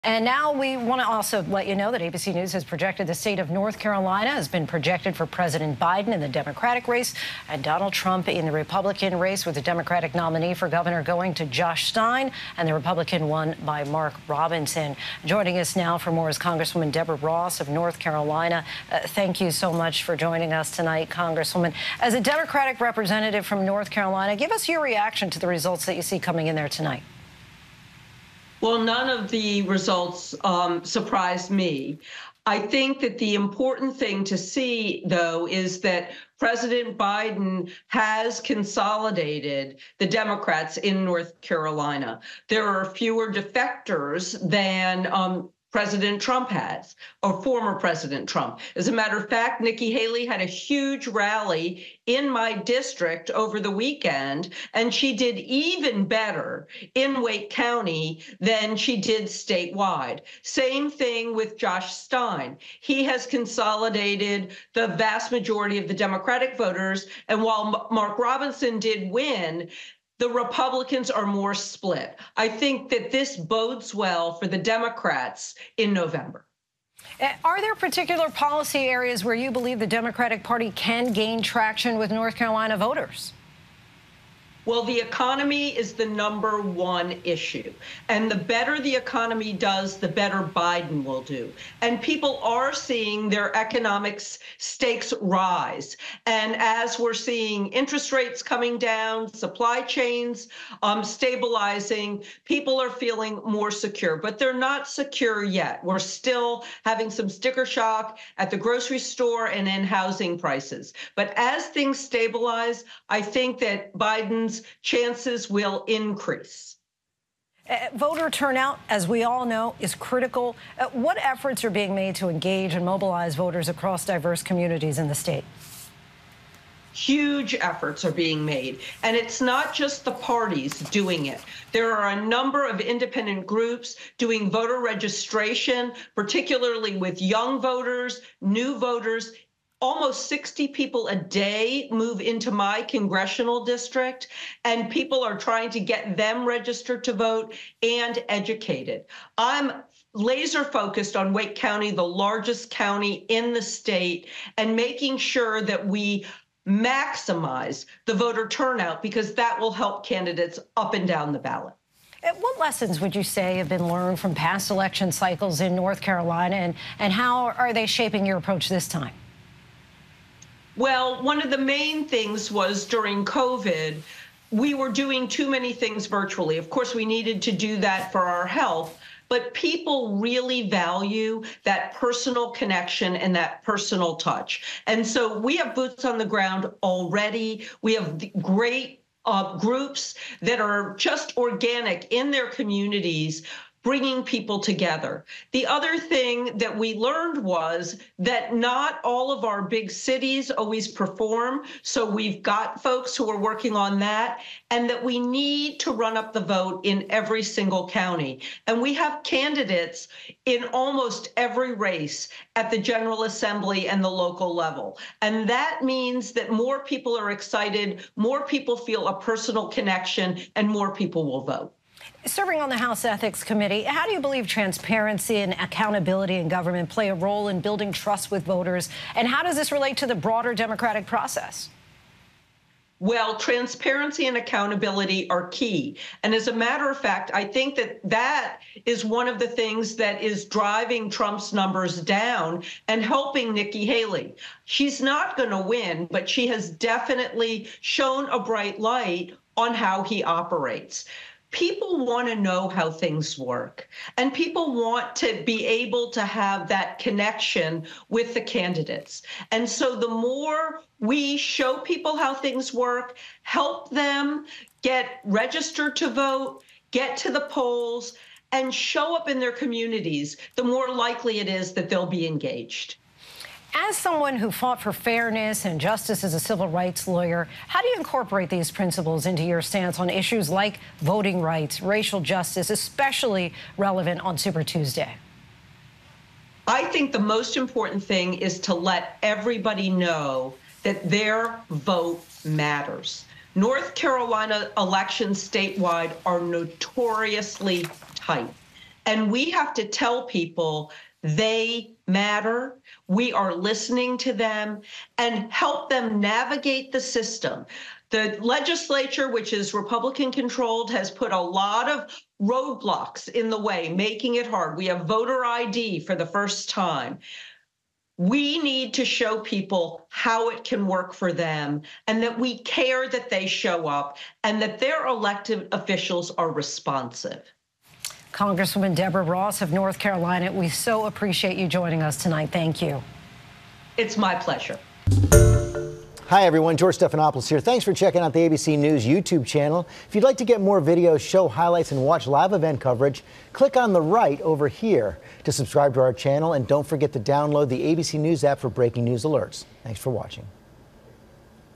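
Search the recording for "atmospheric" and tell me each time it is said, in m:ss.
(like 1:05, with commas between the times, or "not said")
not said.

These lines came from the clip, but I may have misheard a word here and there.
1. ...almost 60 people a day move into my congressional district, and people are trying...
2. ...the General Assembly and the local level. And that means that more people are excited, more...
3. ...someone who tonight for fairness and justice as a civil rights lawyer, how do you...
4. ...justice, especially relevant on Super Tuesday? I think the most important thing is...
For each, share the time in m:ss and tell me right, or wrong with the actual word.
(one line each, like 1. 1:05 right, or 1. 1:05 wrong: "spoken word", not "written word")
1. 2:19 right
2. 3:32 right
3. 4:33 wrong: "fought", not "tonight"
4. 4:42 right.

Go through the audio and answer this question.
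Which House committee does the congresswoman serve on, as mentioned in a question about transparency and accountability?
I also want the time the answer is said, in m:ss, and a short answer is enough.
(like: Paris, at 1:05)
House Ethics Committee, at 3:42.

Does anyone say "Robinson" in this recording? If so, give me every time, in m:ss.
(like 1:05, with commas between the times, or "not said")
0:14, 1:08.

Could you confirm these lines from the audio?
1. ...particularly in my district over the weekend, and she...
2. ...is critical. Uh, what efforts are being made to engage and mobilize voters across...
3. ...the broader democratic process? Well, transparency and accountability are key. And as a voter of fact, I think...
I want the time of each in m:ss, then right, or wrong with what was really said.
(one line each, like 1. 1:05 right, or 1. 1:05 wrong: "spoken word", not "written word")
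1. 0:51 wrong: "rally", not "particularly"
2. 1:59 right
3. 3:50 wrong: "matter", not "voter".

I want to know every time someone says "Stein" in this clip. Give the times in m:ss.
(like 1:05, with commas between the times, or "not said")
0:11, 1:01.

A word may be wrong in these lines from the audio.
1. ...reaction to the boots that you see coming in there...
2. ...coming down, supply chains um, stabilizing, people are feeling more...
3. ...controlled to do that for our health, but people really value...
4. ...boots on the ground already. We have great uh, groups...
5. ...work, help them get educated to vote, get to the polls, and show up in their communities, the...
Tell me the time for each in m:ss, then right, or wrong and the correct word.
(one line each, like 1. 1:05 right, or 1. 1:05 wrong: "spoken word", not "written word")
1. 0:24 wrong: "results", not "boots"
2. 1:38 right
3. 2:57 wrong: "needed", not "controlled"
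4. 3:05 right
5. 4:22 wrong: "registered", not "educated".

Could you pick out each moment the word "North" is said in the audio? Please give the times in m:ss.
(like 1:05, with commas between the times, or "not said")
0:03, 0:17, 0:23, 0:41, 1:22, 2:45, 4:53, 5:29.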